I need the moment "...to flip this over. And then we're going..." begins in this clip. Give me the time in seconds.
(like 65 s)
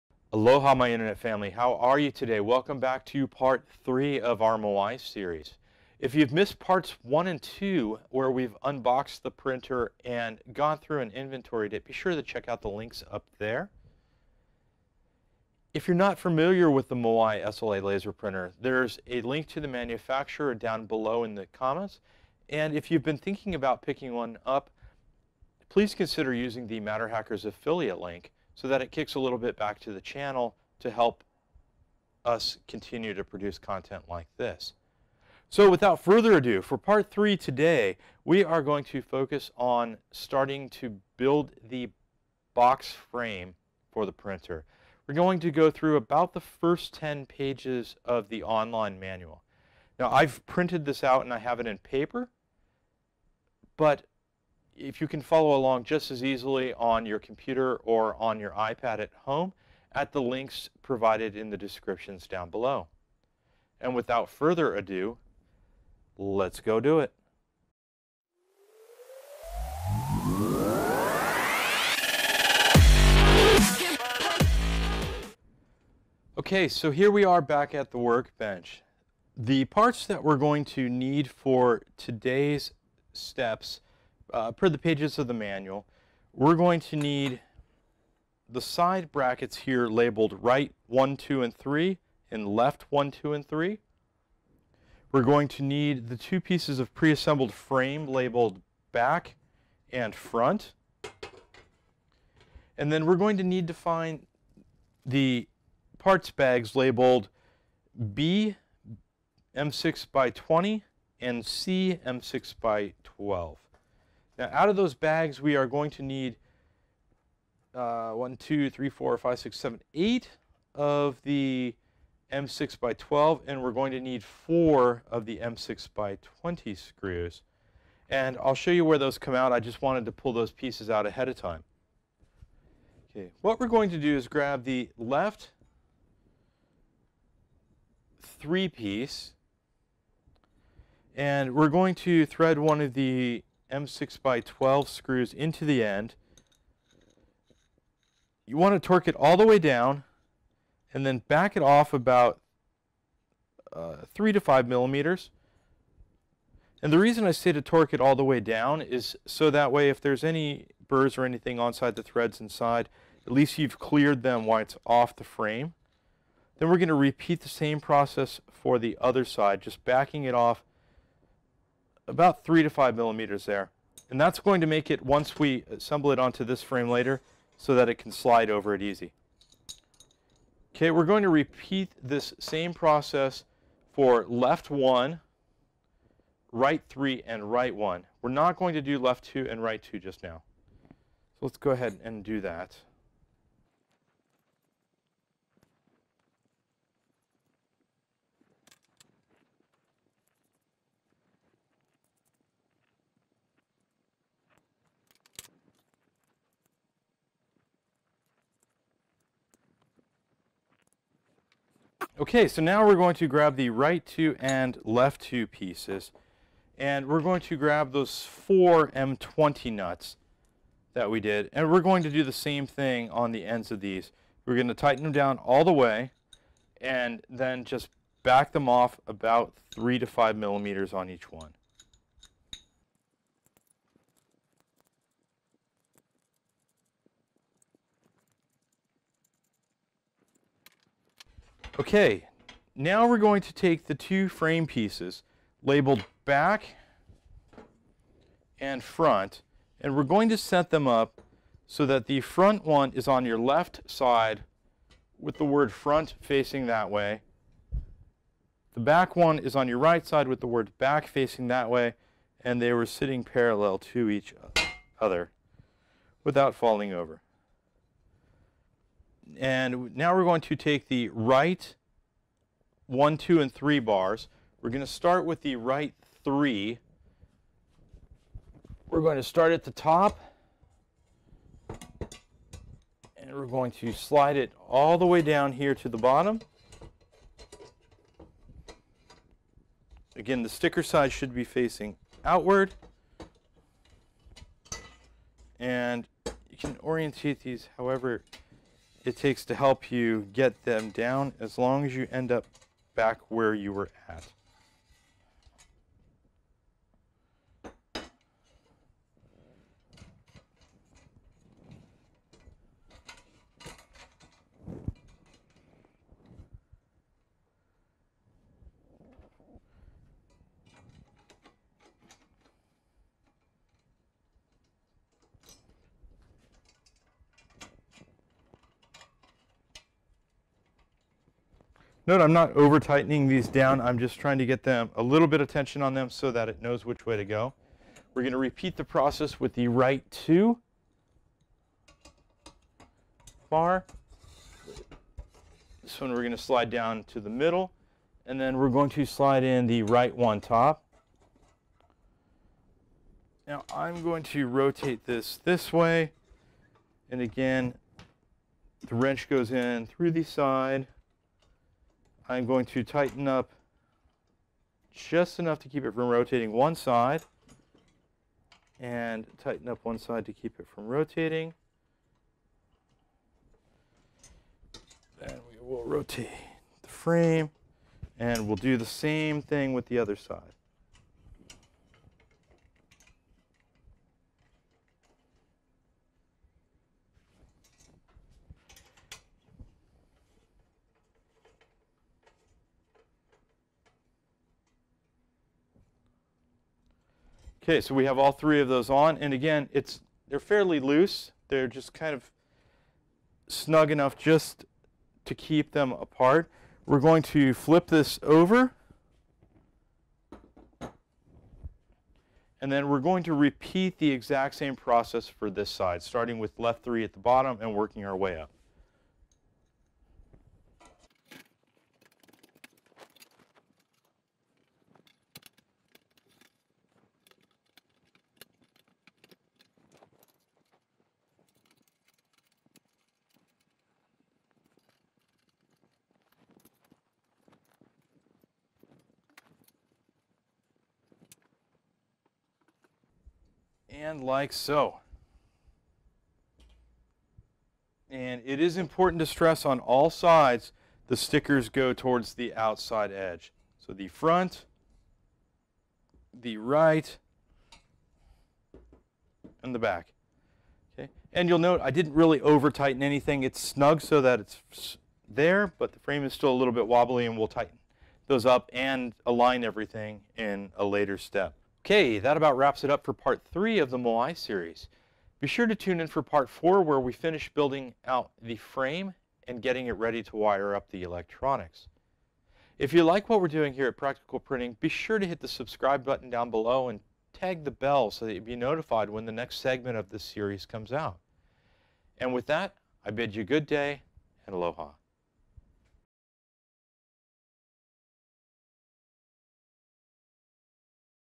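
407 s.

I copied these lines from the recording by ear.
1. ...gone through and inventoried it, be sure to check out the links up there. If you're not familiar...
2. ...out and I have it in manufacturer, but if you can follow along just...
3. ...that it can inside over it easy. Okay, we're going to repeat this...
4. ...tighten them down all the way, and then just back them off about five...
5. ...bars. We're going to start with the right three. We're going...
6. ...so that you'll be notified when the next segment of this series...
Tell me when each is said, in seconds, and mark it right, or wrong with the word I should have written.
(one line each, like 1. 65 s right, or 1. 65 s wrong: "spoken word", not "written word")
1. 10 s right
2. 51 s wrong: "paper", not "manufacturer"
3. 177 s wrong: "slide", not "inside"
4. 224 s wrong: "three", not "five"
5. 273 s right
6. 488 s right.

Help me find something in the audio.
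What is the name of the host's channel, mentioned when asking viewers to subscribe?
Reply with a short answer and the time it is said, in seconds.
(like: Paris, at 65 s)
Practical Printing, at 483 s.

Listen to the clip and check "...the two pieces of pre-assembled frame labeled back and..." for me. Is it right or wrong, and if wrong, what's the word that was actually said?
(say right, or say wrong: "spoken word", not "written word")
right.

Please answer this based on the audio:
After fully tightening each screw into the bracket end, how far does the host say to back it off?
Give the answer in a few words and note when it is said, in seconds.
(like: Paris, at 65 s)
3 to 5 millimeters, at 154 s.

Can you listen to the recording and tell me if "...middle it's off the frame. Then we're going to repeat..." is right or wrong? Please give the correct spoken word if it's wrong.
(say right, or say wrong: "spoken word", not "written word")
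wrong: "while", not "middle".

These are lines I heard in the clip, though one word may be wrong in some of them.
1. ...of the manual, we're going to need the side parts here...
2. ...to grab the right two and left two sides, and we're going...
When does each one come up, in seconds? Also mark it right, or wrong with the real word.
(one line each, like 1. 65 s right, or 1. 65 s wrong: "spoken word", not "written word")
1. 85 s wrong: "brackets", not "parts"
2. 213 s wrong: "pieces", not "sides".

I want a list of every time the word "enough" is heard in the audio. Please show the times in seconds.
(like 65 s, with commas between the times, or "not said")
365 s, 403 s.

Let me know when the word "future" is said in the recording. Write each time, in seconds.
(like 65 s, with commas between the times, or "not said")
not said.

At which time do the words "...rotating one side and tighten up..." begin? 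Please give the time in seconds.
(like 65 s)
366 s.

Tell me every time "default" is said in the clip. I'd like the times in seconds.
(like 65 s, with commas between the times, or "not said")
not said.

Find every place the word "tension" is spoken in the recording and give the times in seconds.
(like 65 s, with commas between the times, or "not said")
335 s.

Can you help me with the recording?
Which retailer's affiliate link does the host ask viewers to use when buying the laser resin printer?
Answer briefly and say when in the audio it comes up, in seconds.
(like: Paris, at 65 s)
Matter Hackers, at 26 s.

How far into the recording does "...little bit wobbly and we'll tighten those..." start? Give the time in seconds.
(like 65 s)
466 s.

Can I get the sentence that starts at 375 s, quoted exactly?
Then we will rotate the frame and we'll do the same thing with the other side.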